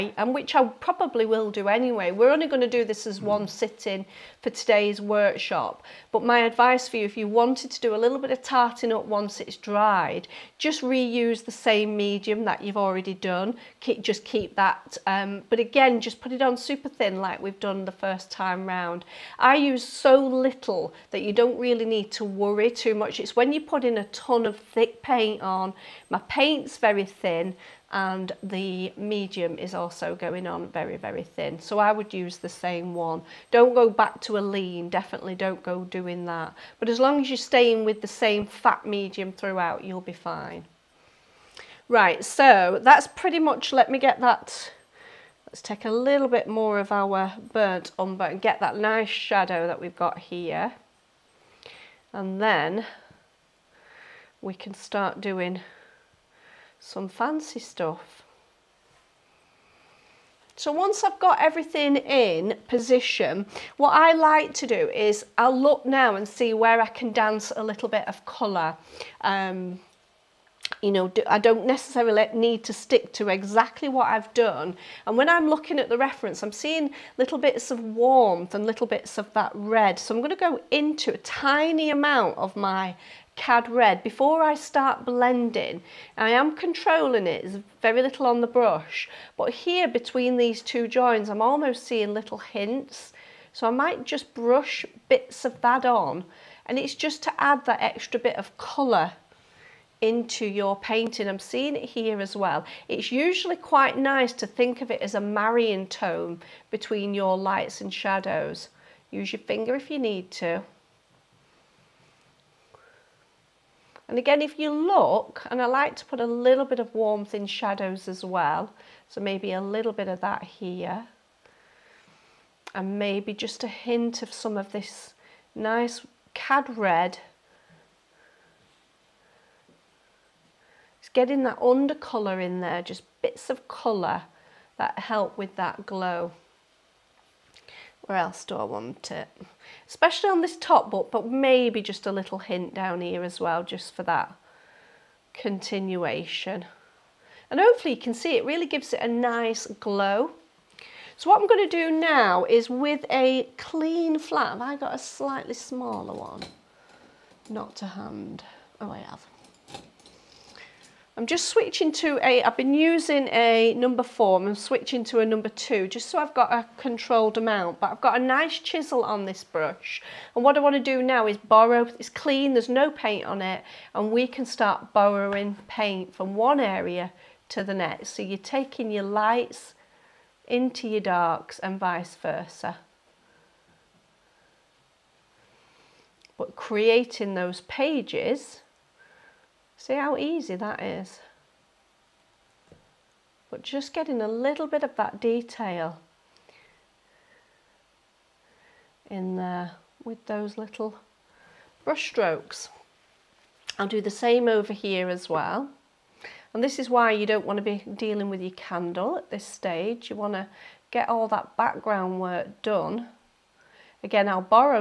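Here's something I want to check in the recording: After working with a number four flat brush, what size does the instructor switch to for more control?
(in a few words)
Number 2.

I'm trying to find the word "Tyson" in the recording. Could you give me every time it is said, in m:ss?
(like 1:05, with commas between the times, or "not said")
not said.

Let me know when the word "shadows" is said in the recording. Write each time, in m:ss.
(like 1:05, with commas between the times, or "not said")
0:49, 1:47, 1:57.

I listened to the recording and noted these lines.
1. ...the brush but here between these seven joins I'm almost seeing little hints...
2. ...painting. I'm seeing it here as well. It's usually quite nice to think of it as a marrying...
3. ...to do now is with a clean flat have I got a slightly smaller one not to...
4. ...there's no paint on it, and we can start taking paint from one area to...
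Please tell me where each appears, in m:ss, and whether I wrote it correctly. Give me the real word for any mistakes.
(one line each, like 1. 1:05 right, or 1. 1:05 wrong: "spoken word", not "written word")
1. 1:28 wrong: "two", not "seven"
2. 1:40 right
3. 2:31 right
4. 2:52 wrong: "borrowing", not "taking".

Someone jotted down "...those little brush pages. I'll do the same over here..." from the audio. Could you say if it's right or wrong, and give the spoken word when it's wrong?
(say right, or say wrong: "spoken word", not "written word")
wrong: "strokes", not "pages".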